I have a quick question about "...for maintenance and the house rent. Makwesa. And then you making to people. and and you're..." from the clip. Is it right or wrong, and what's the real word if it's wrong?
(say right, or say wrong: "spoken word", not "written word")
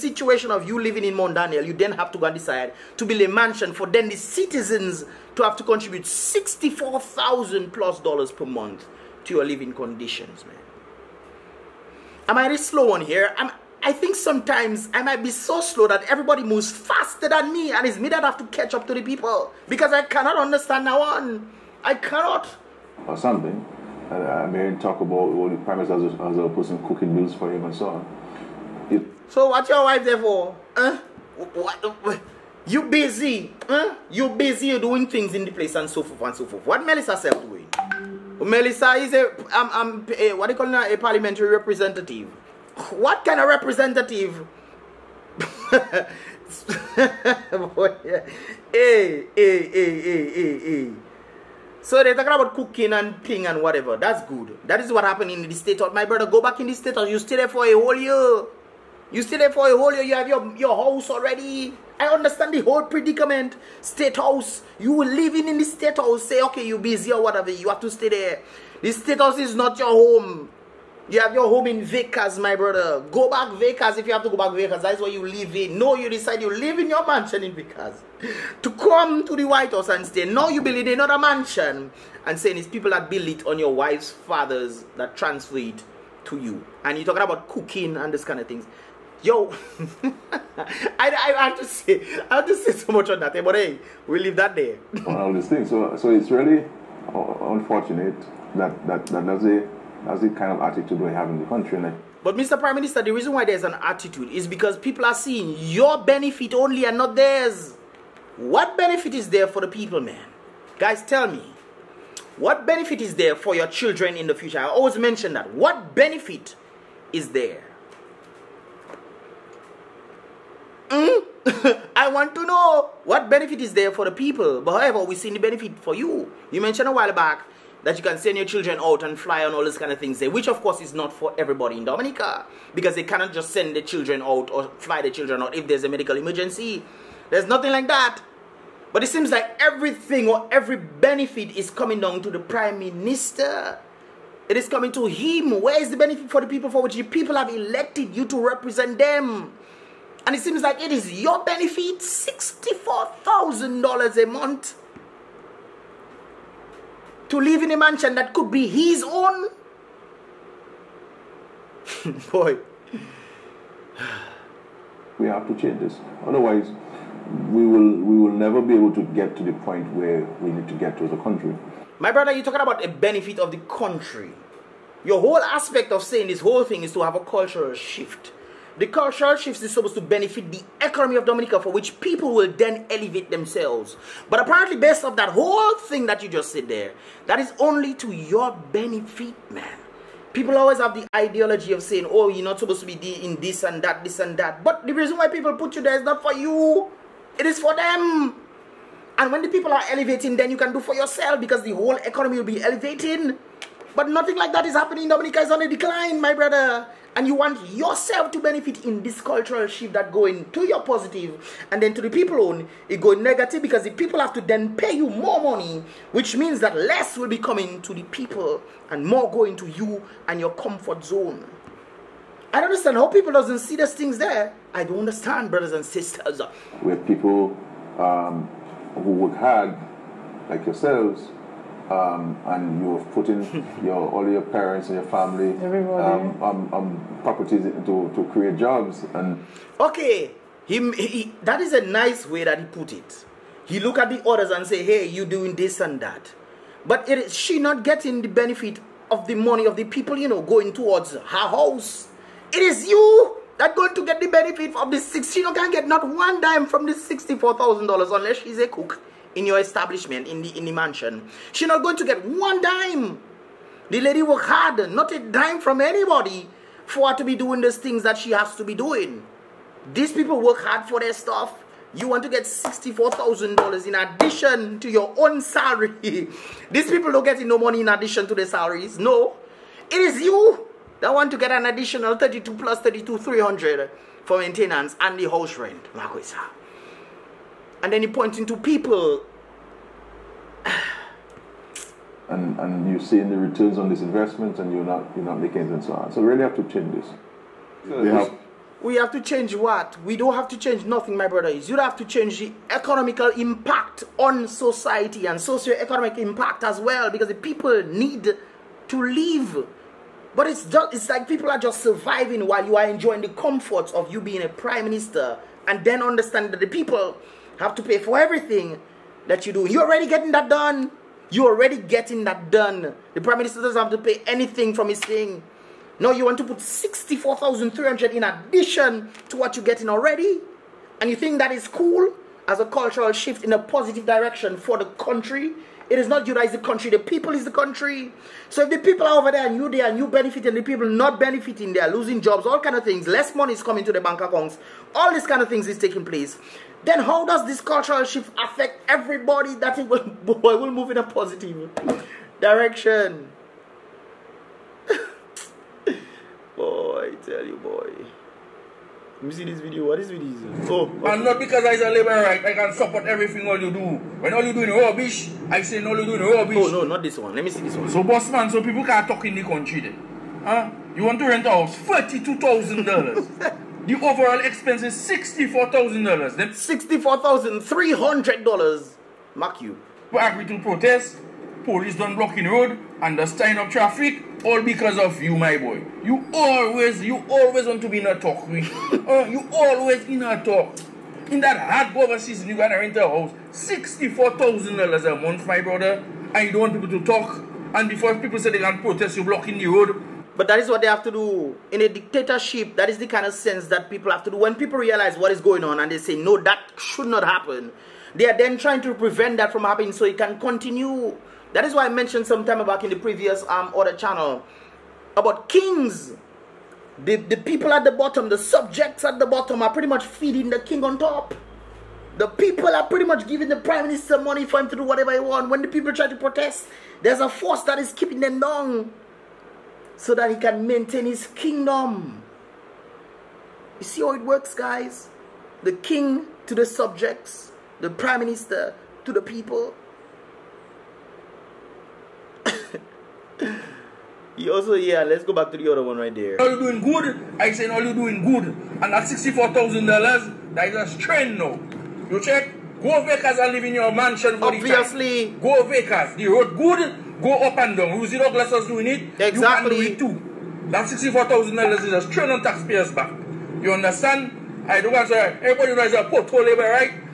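wrong: "pointing", not "making".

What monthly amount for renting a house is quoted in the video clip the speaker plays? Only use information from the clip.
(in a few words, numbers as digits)
$32,000.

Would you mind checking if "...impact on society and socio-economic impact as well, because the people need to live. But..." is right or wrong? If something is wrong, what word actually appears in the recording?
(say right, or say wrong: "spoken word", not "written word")
right.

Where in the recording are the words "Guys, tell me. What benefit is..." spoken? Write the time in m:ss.
1:50.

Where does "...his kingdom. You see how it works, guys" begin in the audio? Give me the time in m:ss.
7:11.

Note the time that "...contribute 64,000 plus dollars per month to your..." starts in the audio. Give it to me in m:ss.
0:05.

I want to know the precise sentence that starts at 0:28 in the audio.
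It, so what's your wife there for?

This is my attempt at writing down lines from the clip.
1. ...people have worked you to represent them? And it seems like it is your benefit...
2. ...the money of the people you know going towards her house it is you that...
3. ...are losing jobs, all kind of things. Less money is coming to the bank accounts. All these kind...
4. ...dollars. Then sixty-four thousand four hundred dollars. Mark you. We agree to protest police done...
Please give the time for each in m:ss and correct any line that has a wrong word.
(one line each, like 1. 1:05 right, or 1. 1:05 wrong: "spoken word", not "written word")
1. 2:27 wrong: "elected", not "worked"
2. 4:09 right
3. 5:41 right
4. 6:16 wrong: "three", not "four".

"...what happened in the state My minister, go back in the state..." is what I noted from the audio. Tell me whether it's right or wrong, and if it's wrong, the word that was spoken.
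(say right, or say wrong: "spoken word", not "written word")
wrong: "brother", not "minister".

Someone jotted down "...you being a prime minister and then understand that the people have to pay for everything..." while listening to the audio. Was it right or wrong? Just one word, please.
right.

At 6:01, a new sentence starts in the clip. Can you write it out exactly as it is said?
and not because is a labor right, I can support everything all you do.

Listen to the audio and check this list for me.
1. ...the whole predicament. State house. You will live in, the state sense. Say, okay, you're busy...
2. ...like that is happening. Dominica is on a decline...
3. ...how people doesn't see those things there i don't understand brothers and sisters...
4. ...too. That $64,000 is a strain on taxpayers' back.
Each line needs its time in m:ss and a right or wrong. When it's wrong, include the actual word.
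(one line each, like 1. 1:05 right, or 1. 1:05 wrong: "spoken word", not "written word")
1. 1:02 wrong: "house", not "sense"
2. 3:24 right
3. 3:42 right
4. 7:40 right.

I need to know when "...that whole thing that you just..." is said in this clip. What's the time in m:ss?
3:05.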